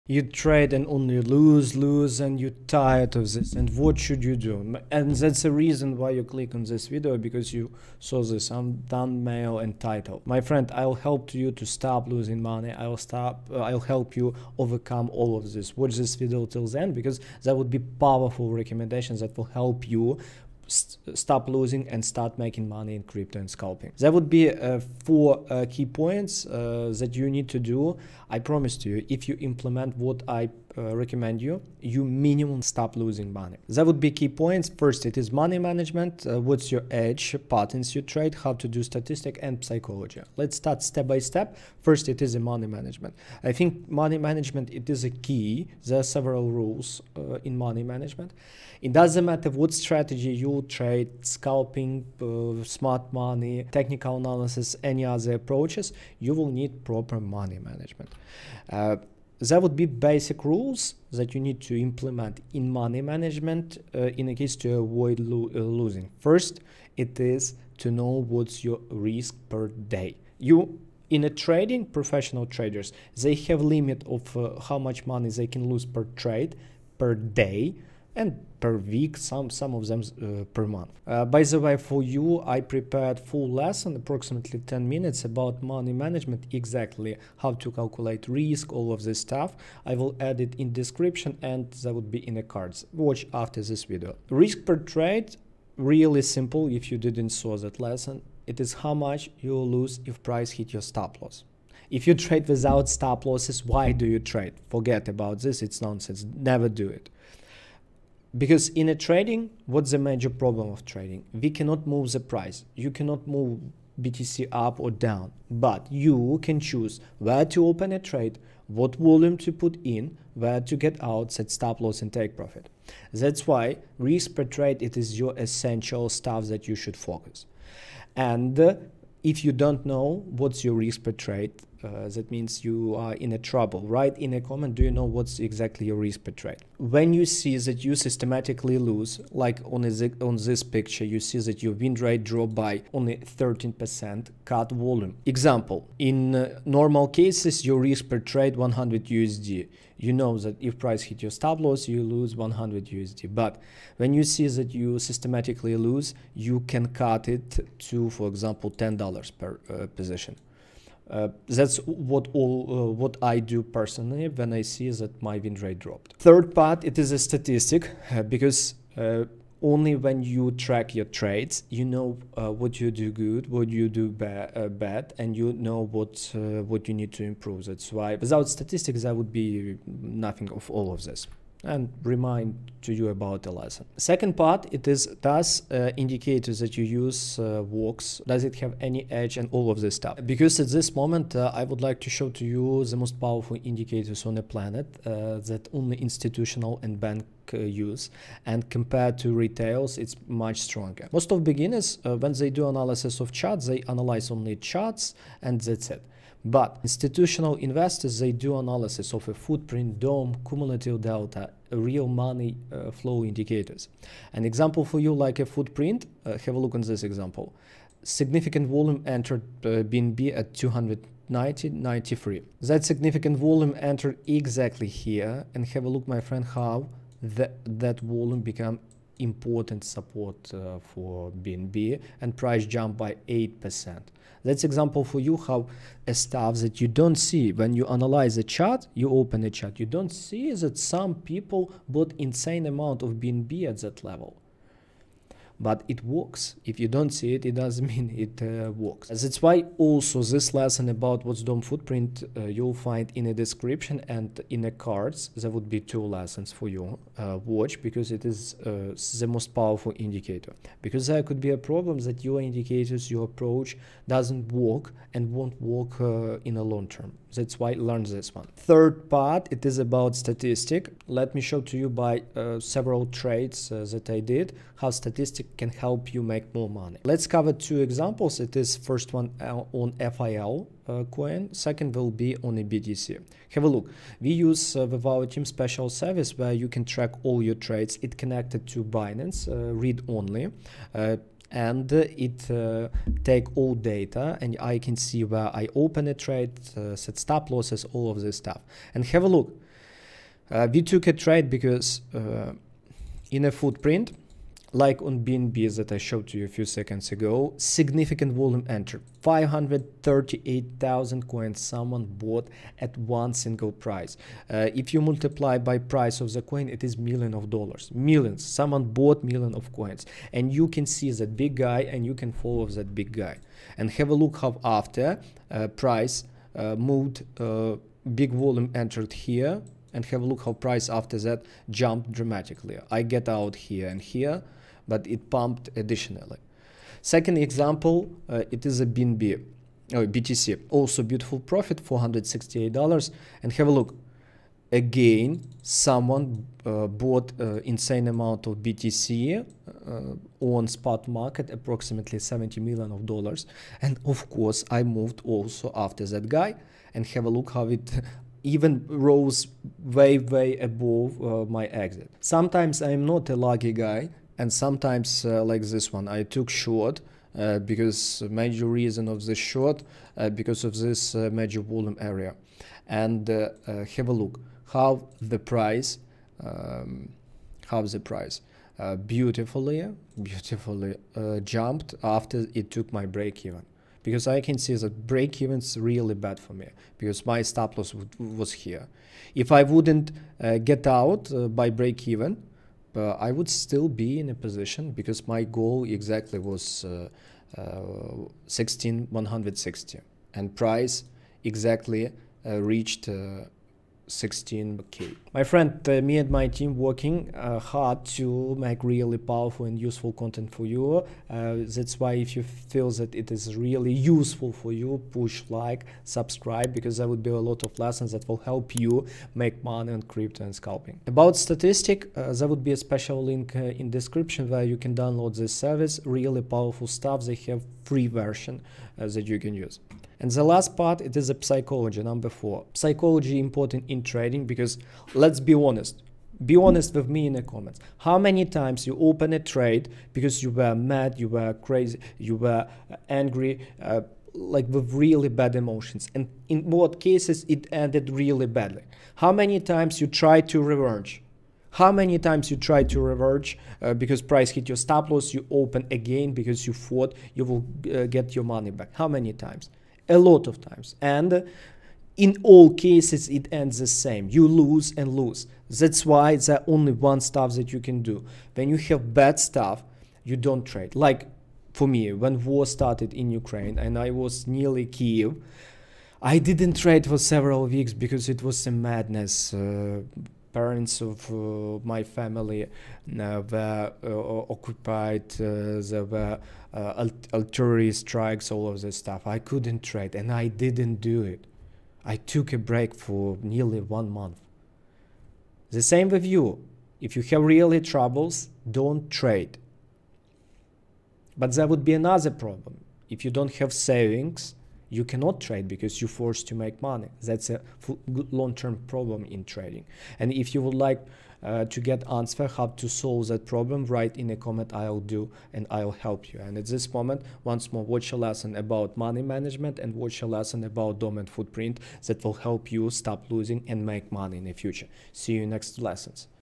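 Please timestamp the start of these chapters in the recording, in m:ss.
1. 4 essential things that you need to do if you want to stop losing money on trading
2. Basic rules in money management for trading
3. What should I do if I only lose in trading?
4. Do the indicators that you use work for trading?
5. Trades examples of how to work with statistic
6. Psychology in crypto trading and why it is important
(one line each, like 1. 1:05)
1. 0:26
2. 0:42
3. 2:20
4. 3:05
5. 4:30
6. 7:12.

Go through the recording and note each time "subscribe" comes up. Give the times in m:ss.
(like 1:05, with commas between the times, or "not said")
6:56.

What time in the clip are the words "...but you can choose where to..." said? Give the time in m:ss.
1:55.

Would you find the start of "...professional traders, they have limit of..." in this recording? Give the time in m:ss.
1:11.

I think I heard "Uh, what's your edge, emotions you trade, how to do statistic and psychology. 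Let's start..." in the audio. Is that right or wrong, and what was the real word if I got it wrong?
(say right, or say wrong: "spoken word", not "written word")
wrong: "patterns", not "emotions".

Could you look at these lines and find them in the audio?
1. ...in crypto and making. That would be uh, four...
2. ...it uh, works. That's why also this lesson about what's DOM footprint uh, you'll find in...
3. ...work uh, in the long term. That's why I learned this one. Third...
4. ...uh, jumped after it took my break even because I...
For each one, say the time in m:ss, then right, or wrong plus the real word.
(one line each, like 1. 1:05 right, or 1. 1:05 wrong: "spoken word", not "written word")
1. 0:22 wrong: "scalping", not "making"
2. 4:08 right
3. 4:25 right
4. 6:21 right.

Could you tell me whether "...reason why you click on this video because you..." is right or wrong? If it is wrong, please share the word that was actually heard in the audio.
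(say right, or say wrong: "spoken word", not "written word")
right.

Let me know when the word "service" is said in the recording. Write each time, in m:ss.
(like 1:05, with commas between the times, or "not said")
4:45, 7:05.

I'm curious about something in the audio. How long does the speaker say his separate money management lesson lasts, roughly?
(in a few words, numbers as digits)
10 minutes.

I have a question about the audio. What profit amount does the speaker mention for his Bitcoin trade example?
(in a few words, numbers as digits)
$468.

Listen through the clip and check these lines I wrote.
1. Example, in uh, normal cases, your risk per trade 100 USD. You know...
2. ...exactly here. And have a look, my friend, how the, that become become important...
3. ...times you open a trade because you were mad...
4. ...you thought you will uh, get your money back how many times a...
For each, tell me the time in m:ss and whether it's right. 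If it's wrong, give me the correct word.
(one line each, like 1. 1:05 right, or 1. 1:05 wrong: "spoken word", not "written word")
1. 2:25 right
2. 3:44 wrong: "volume", not "become"
3. 7:18 right
4. 7:36 right.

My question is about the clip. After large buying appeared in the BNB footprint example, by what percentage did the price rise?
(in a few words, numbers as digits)
8%.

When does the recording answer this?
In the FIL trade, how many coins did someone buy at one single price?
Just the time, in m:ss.
5:09.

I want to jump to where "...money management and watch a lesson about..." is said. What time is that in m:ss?
8:38.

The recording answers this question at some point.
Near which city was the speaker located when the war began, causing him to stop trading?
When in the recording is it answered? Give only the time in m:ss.
7:54.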